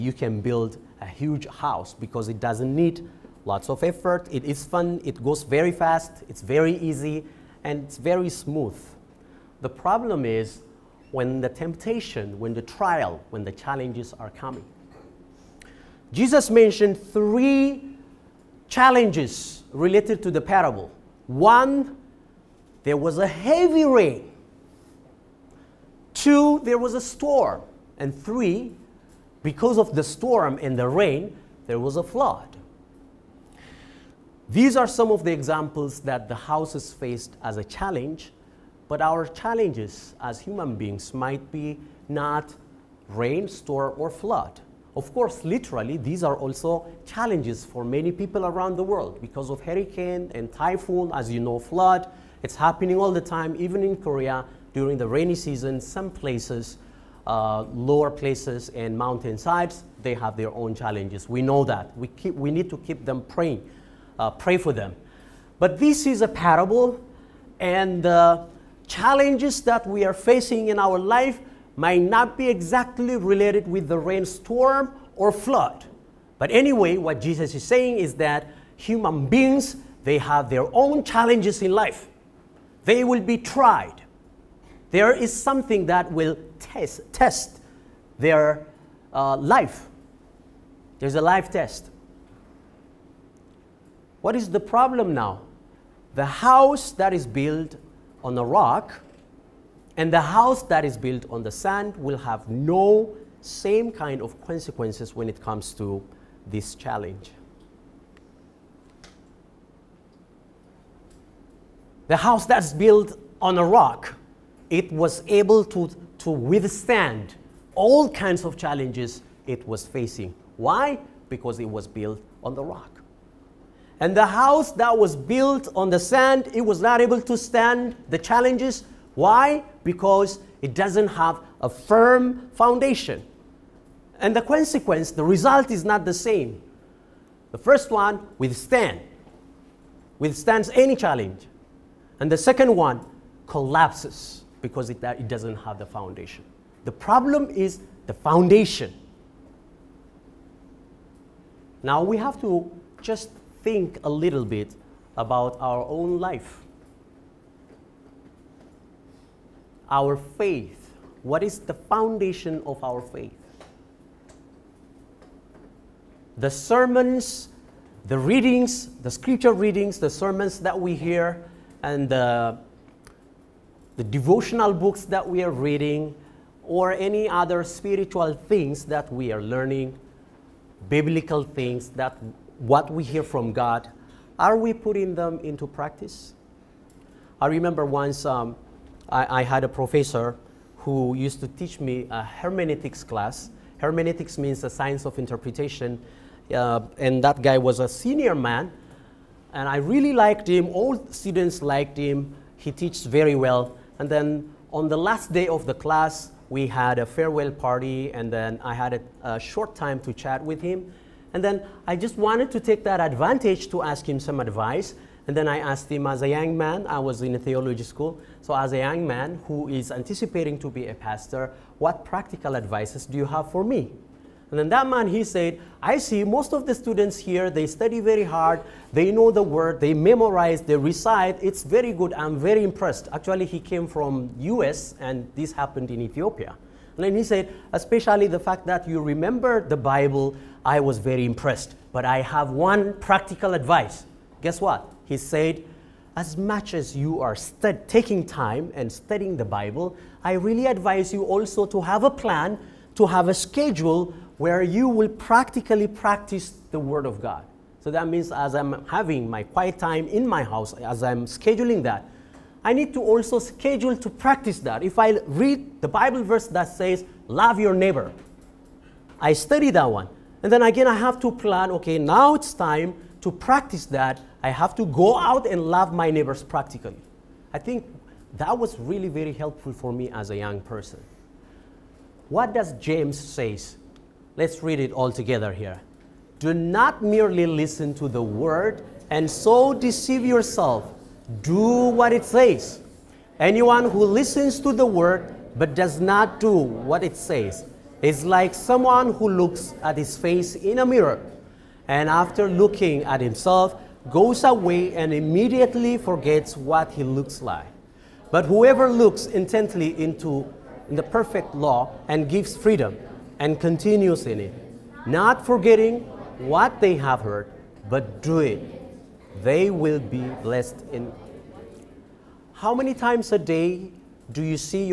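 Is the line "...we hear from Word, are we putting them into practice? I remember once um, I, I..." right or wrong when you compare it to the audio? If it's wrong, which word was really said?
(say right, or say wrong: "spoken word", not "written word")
wrong: "God", not "Word".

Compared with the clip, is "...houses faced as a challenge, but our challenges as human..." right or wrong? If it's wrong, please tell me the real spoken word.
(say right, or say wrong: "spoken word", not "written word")
right.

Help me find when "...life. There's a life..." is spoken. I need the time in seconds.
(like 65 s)
89 s.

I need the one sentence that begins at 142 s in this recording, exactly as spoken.
And the second one, collapses because it, it doesn't have the foundation.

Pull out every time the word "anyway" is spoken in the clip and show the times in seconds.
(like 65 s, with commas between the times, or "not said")
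76 s.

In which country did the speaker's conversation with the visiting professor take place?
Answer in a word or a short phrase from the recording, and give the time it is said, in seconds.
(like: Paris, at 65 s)
Ethiopia, at 236 s.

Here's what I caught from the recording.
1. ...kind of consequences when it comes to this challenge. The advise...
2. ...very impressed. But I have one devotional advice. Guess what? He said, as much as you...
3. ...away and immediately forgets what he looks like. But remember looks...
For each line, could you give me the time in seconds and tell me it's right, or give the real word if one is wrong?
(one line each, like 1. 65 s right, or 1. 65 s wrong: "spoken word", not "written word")
1. 103 s wrong: "house", not "advise"
2. 240 s wrong: "practical", not "devotional"
3. 304 s wrong: "whoever", not "remember".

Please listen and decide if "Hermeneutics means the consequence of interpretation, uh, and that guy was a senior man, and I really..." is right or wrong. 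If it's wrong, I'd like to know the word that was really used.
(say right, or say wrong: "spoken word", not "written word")
wrong: "science", not "consequence".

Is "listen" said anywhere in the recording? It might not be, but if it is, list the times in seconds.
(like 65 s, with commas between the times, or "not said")
287 s, 294 s.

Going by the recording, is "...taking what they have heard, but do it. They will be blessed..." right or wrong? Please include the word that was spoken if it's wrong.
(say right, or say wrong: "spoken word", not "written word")
wrong: "forgetting", not "taking".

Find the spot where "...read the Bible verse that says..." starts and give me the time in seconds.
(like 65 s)
265 s.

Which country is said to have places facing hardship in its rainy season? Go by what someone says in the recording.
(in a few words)
Korea.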